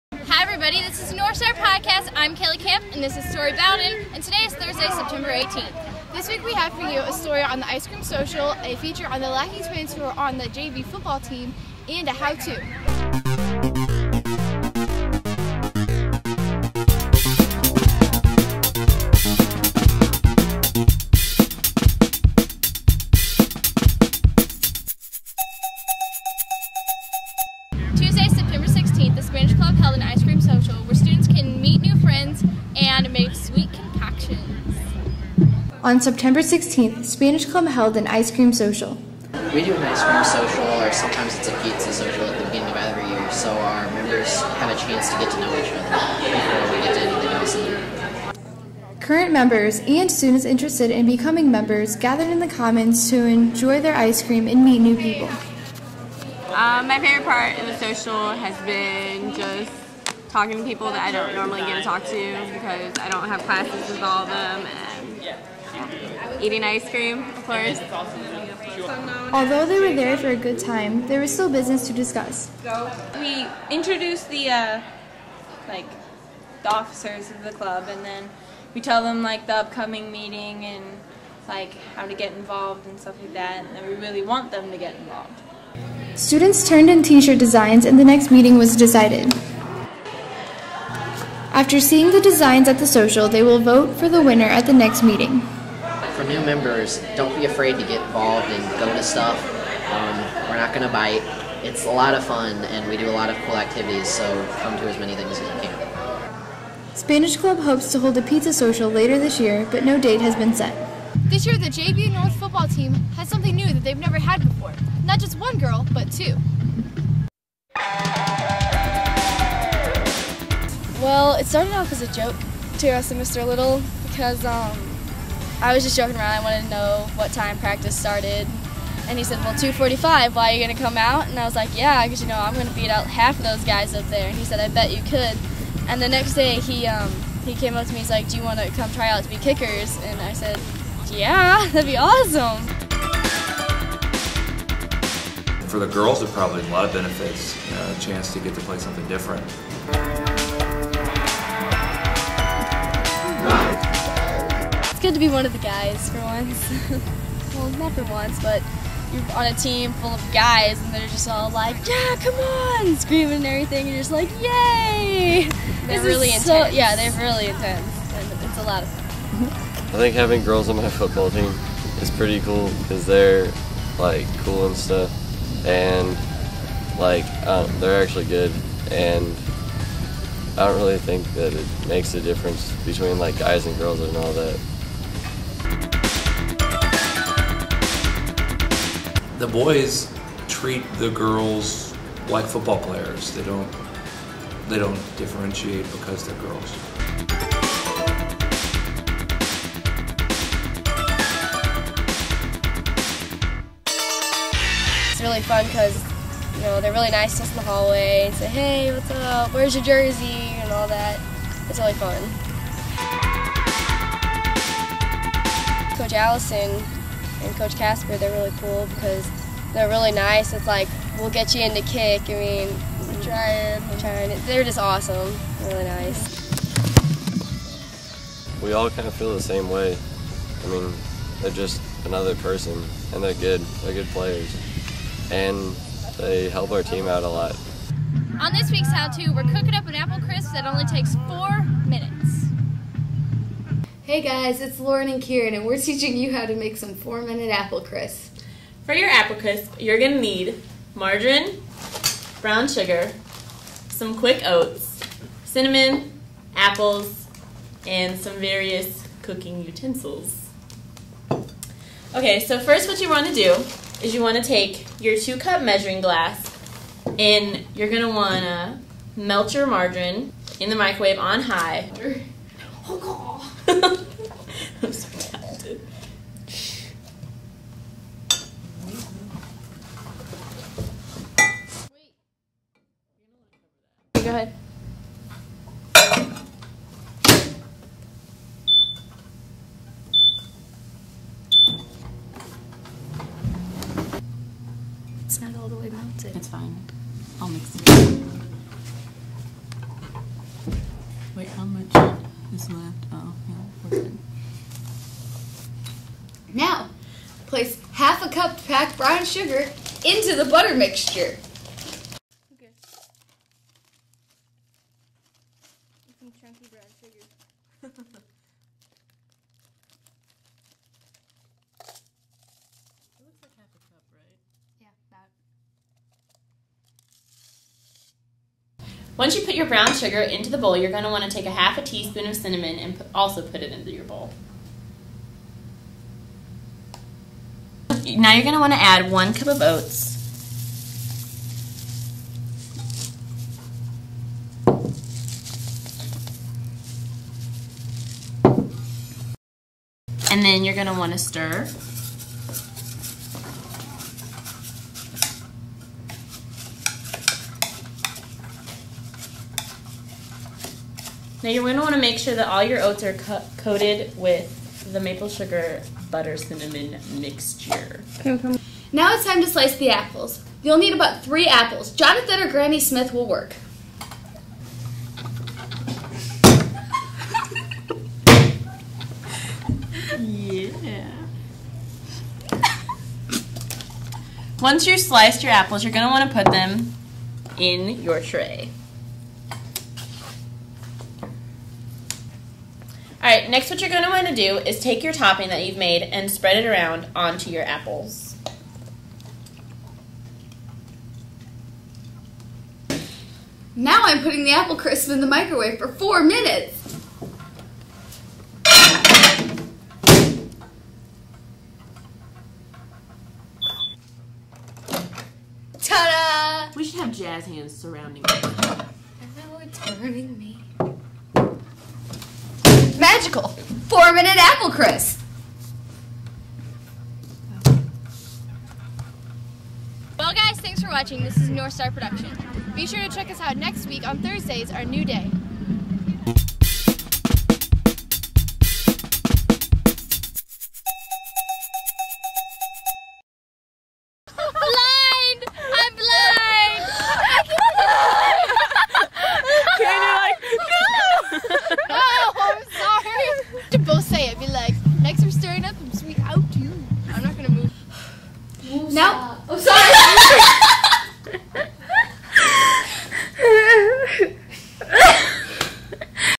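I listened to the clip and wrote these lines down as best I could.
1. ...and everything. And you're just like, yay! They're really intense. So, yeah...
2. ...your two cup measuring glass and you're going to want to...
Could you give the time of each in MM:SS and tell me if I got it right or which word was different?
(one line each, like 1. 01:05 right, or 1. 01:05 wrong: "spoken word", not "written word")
1. 02:43 right
2. 04:25 right.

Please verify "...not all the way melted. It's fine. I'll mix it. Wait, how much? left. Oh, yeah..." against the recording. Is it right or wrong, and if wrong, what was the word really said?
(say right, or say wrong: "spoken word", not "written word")
right.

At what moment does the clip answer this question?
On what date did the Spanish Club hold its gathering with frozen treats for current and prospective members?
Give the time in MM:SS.
00:35.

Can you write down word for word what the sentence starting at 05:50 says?
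And then you're going to want to stir.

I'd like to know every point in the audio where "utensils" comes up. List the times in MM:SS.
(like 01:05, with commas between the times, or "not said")
04:19.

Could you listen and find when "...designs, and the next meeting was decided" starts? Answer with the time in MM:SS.
01:27.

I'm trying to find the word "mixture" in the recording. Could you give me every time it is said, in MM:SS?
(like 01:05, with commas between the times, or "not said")
05:10, 06:07.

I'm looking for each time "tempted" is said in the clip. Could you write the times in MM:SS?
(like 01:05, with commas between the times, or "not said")
04:35.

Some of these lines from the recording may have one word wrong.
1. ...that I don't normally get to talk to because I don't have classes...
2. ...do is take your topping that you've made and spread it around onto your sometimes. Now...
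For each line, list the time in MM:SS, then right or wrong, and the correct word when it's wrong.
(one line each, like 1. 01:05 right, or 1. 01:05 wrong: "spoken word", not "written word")
1. 01:00 right
2. 06:34 wrong: "apples", not "sometimes".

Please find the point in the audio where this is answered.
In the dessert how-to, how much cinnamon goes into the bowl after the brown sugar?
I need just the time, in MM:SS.
05:31.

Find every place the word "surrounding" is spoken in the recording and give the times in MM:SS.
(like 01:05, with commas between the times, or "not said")
06:57.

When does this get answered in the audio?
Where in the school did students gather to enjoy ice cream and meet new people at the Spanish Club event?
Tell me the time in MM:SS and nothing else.
00:52.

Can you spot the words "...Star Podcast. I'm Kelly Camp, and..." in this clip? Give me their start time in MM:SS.
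00:01.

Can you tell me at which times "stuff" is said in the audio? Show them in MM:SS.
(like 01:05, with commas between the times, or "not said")
01:22, 01:39, 02:54.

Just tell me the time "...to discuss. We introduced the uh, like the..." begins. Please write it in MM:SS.
01:11.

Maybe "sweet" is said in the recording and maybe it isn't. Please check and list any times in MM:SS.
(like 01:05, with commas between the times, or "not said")
not said.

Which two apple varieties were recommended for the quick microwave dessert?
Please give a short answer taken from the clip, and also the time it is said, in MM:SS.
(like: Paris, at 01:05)
Jonathan or Granny Smith, at 06:11.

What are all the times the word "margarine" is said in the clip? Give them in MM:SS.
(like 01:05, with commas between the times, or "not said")
04:10, 04:29.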